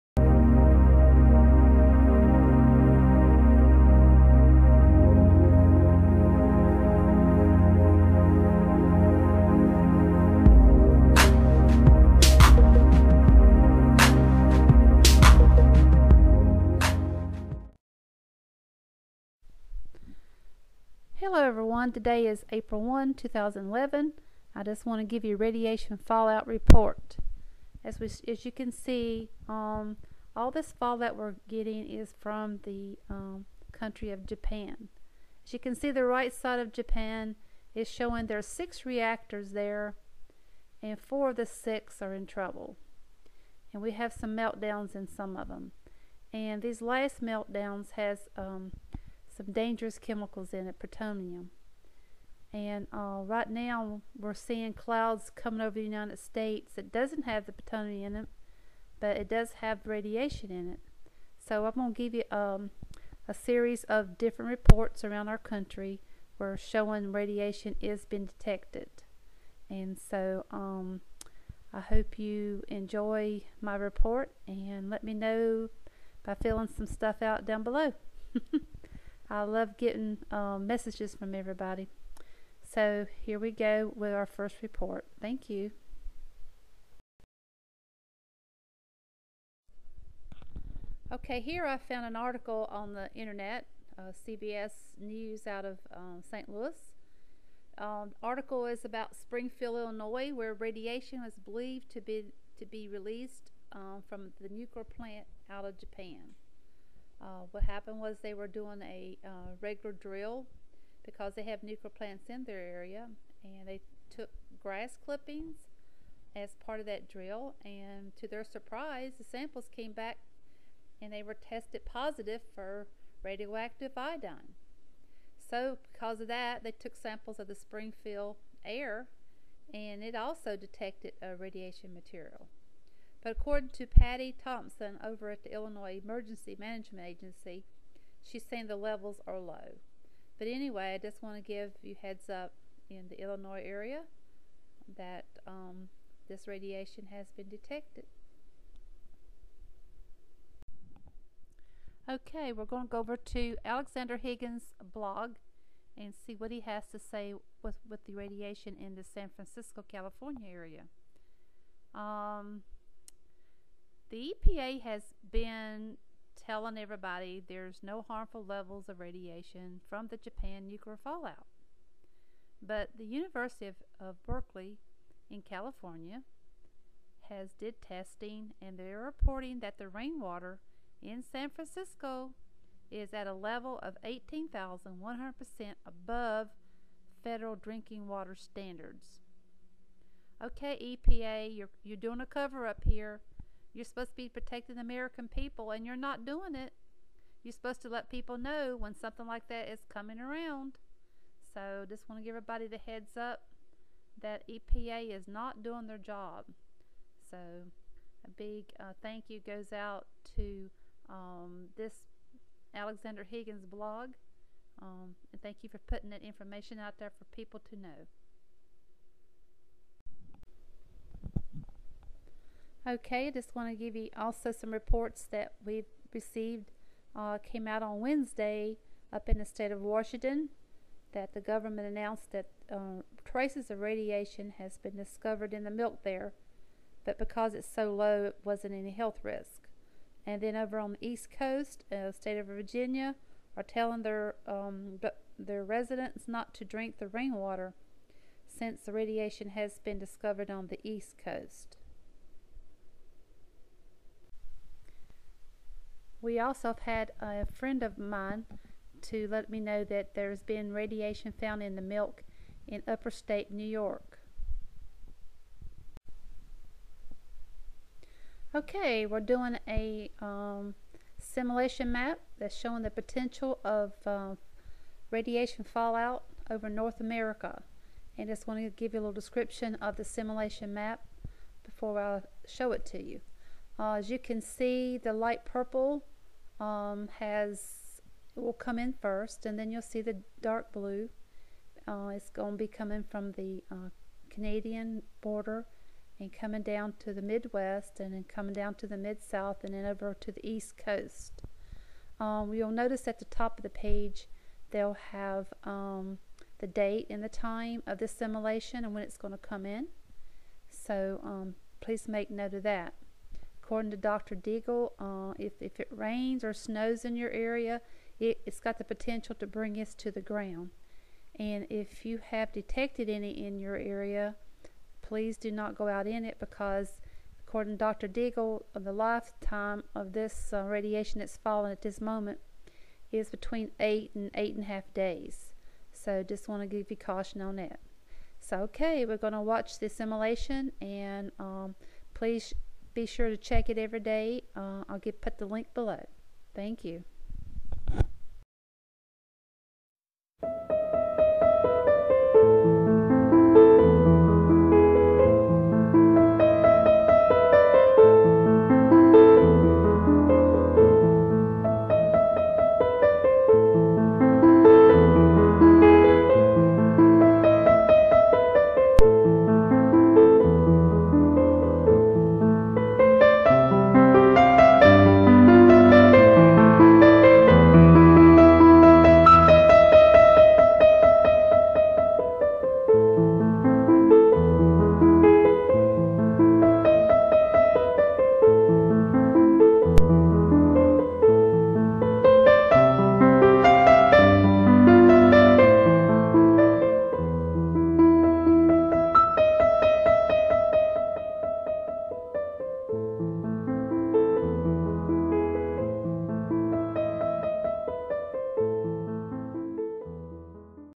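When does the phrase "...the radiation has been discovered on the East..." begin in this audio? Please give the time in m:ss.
4:08.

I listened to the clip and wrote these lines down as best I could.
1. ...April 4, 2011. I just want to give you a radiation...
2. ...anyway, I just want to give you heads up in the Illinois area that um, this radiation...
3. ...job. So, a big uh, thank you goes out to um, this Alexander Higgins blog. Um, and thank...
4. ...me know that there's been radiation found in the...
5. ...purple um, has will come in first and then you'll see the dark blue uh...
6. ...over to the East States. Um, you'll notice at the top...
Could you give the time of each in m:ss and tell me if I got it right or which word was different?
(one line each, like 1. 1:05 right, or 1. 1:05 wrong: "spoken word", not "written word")
1. 0:22 wrong: "1", not "4"
2. 2:20 right
3. 3:25 right
4. 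4:19 right
5. 4:45 right
6. 4:59 wrong: "Coast", not "States".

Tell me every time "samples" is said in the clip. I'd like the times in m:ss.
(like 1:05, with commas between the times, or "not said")
1:59, 2:06.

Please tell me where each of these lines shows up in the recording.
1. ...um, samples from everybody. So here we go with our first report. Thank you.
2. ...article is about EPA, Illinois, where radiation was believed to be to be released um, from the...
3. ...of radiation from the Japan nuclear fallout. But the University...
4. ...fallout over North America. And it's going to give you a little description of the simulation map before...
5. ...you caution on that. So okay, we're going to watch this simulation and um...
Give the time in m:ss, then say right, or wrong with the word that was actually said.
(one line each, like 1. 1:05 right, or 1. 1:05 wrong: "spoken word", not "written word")
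1. 1:20 wrong: "messages", not "samples"
2. 1:38 wrong: "Springfield", not "EPA"
3. 2:48 right
4. 4:35 right
5. 5:36 right.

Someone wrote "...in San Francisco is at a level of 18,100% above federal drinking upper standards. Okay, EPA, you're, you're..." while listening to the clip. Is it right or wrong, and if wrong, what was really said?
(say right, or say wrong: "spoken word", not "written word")
wrong: "water", not "upper".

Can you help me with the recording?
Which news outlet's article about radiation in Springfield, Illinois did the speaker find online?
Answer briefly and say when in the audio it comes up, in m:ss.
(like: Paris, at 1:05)
CBS News, at 1:34.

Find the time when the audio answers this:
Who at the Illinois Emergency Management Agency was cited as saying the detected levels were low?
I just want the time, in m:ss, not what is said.
2:13.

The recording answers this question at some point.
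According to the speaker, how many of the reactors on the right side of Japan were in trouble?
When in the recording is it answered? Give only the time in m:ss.
0:40.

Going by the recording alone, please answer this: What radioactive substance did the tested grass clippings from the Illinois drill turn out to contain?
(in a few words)
radioactive iodine.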